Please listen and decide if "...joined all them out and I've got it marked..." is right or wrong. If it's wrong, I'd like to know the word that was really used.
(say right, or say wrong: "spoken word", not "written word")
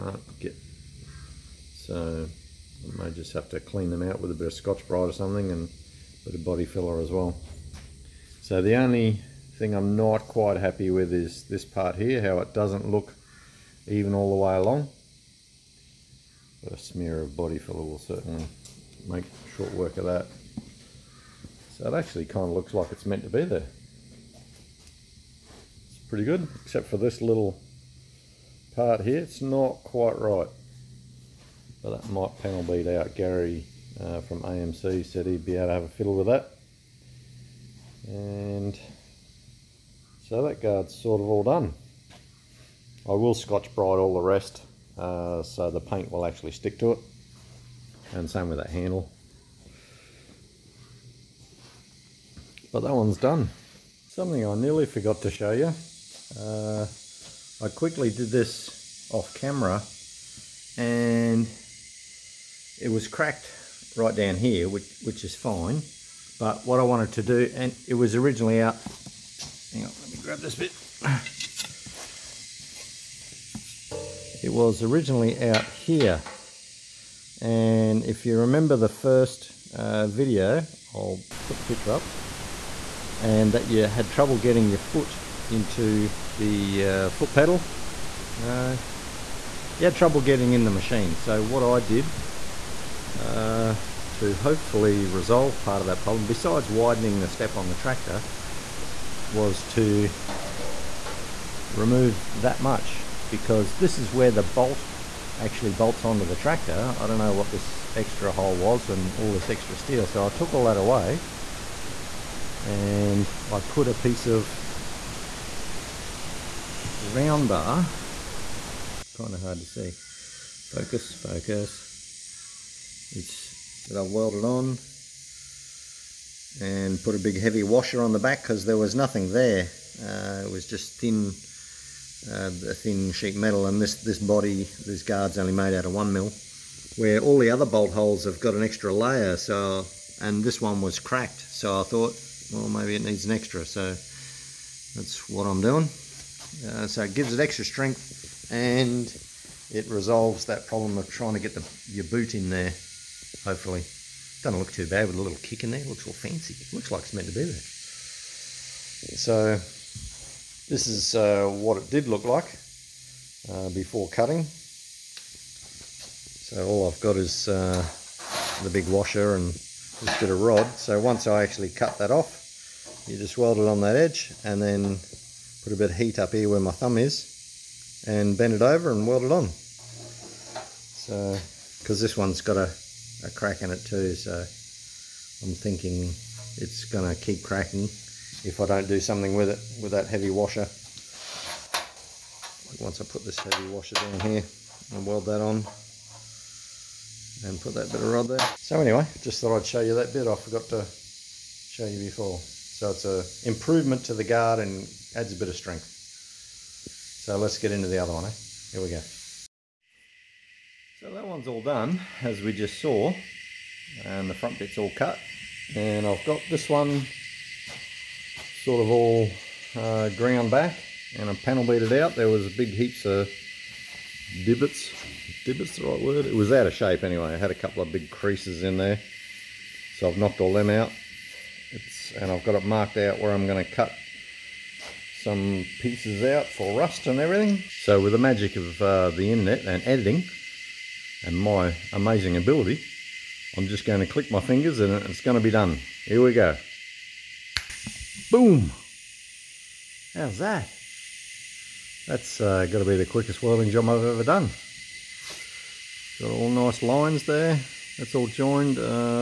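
wrong: "knocked", not "joined".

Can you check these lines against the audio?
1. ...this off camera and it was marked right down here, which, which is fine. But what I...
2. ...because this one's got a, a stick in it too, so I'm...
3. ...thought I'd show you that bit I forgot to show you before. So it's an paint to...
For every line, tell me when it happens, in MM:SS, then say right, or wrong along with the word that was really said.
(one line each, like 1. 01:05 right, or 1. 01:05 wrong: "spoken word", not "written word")
1. 00:58 wrong: "cracked", not "marked"
2. 03:01 wrong: "crack", not "stick"
3. 03:19 wrong: "improvement", not "paint".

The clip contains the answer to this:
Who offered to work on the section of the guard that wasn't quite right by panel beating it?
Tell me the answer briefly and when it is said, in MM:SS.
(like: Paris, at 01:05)
Gary, at 00:33.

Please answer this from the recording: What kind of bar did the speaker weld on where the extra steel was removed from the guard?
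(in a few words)
Round bar.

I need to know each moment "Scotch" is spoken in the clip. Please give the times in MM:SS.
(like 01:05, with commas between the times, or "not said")
00:04, 00:43.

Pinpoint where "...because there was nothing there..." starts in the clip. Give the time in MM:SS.
02:08.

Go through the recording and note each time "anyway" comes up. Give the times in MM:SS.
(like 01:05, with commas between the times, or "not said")
03:18, 03:47.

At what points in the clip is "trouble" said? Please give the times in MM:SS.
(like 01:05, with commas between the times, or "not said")
01:24, 01:29.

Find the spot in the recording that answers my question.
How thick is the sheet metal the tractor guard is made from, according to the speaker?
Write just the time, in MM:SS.
02:15.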